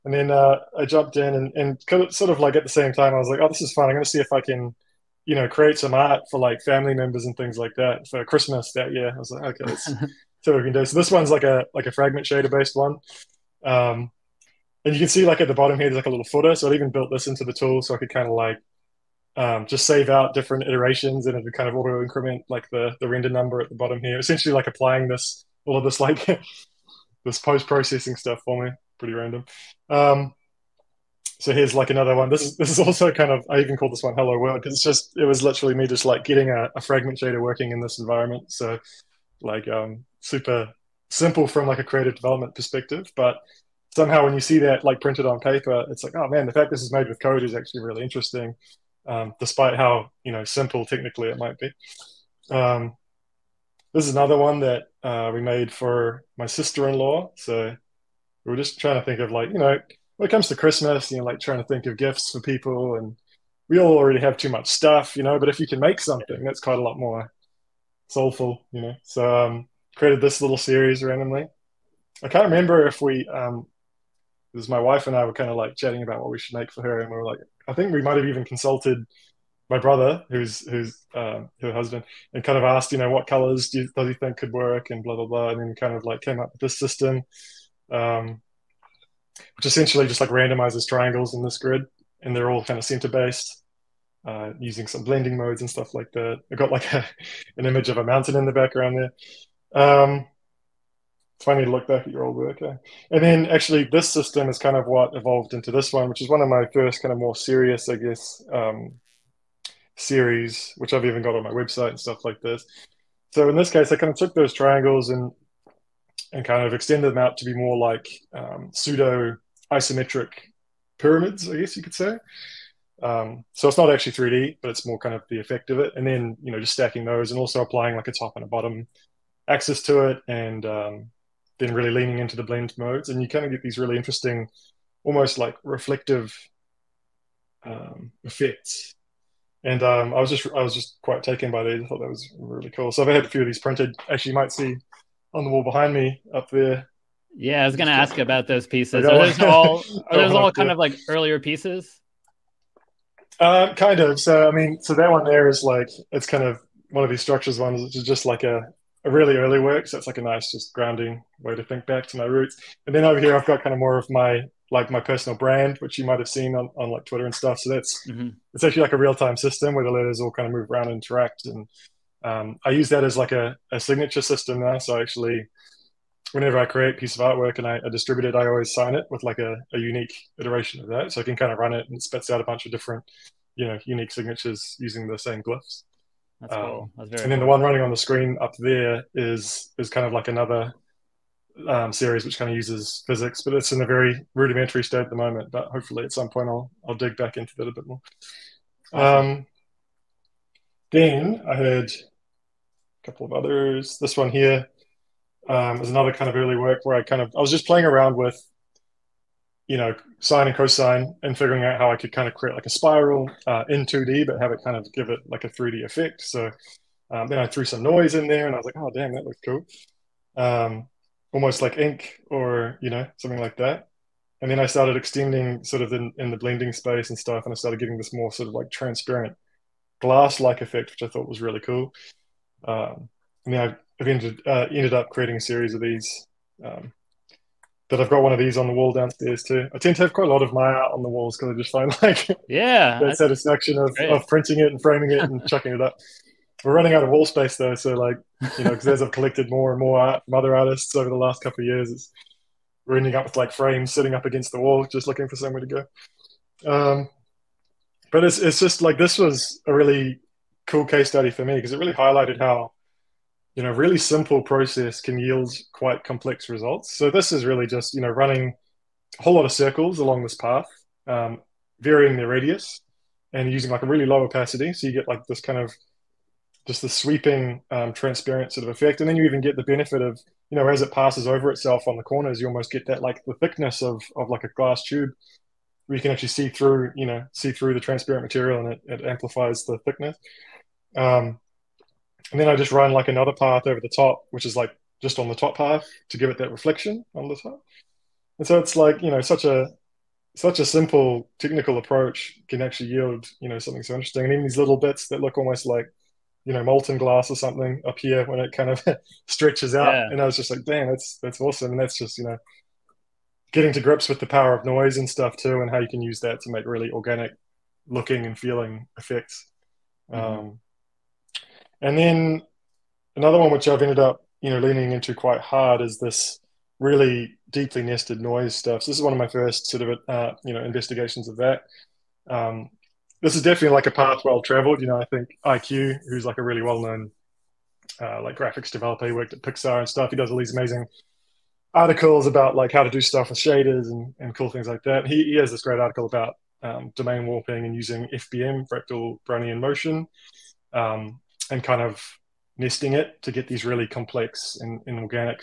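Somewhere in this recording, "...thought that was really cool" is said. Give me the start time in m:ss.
2:21.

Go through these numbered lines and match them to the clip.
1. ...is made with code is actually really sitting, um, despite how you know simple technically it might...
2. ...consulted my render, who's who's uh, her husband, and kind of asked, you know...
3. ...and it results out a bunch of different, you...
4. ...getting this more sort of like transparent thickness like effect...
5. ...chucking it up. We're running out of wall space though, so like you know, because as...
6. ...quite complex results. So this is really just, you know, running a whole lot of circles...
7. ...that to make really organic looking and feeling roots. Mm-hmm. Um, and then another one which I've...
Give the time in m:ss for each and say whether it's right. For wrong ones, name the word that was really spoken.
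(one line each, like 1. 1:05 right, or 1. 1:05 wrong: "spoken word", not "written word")
1. 0:46 wrong: "interesting", not "sitting"
2. 1:18 wrong: "brother", not "render"
3. 3:01 wrong: "spits", not "results"
4. 3:47 wrong: "glass", not "thickness"
5. 4:05 right
6. 4:25 right
7. 5:16 wrong: "effects", not "roots".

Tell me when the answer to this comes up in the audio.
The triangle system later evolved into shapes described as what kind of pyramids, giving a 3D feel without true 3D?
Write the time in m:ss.
1:58.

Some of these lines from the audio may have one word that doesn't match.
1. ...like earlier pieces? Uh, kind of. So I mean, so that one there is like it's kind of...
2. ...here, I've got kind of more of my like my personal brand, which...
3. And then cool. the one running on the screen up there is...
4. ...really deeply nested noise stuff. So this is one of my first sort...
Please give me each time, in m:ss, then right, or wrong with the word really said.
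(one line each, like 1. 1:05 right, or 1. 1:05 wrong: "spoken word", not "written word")
1. 2:30 right
2. 2:43 right
3. 3:07 right
4. 5:26 right.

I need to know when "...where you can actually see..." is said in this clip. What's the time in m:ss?
4:45.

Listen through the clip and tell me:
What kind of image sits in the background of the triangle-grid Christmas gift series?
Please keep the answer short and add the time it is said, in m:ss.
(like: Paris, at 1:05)
A mountain, at 1:37.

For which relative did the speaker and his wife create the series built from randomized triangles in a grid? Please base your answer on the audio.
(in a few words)
Sister-in-law.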